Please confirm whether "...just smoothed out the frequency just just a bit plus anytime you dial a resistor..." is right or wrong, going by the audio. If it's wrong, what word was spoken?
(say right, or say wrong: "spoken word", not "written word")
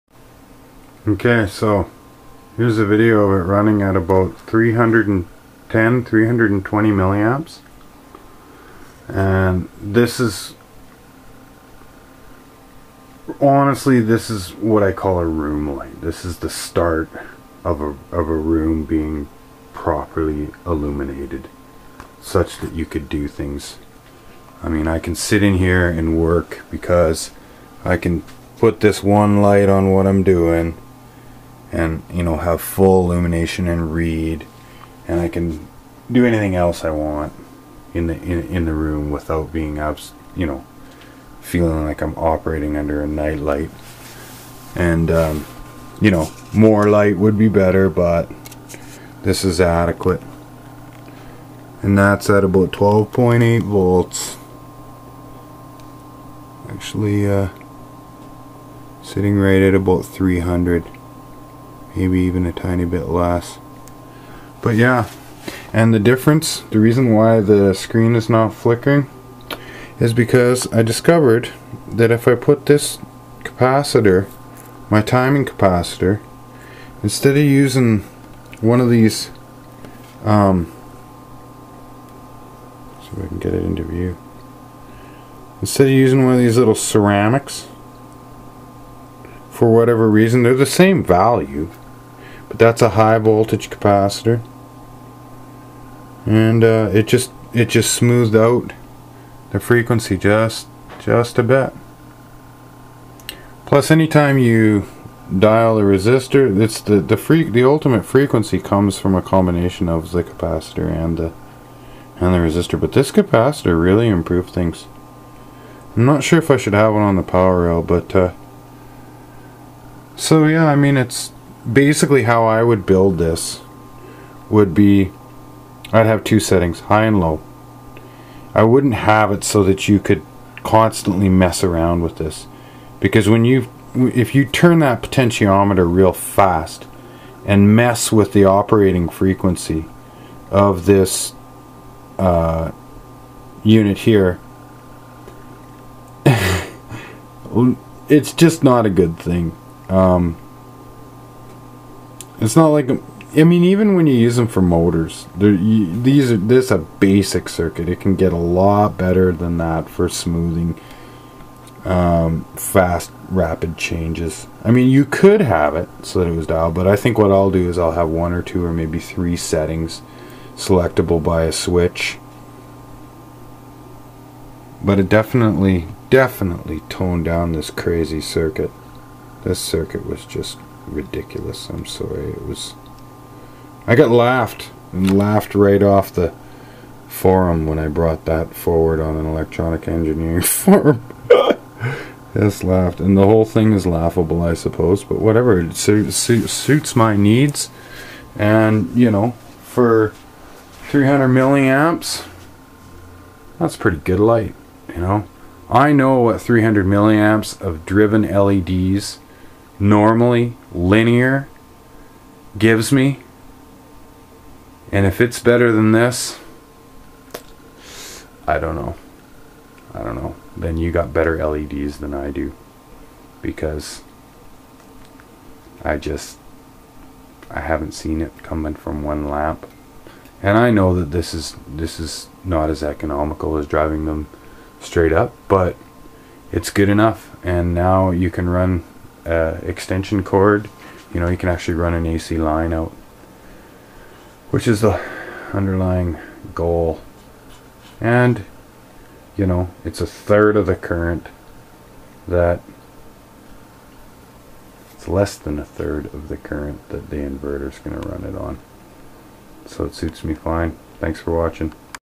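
right.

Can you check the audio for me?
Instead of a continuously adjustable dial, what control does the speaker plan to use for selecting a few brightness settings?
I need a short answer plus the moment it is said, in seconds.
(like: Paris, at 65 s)
a switch, at 171 s.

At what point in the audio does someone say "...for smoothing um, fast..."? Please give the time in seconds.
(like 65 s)
159 s.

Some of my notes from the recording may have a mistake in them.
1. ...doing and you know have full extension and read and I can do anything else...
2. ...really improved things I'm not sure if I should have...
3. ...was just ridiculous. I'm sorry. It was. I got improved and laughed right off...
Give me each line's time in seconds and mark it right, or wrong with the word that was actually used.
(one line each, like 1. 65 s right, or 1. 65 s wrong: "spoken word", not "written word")
1. 30 s wrong: "illumination", not "extension"
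2. 113 s right
3. 180 s wrong: "laughed", not "improved".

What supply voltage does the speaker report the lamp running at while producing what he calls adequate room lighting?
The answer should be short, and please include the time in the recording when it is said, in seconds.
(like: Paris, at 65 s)
12.8 volts, at 52 s.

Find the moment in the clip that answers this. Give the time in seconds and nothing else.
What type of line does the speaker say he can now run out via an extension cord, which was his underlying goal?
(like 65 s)
242 s.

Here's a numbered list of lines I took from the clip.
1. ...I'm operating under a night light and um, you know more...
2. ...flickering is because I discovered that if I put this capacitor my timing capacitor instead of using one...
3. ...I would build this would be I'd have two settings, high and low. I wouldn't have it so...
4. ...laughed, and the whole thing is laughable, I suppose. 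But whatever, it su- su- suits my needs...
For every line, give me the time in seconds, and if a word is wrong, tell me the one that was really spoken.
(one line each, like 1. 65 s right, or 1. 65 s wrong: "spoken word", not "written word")
1. 42 s right
2. 68 s right
3. 122 s right
4. 192 s right.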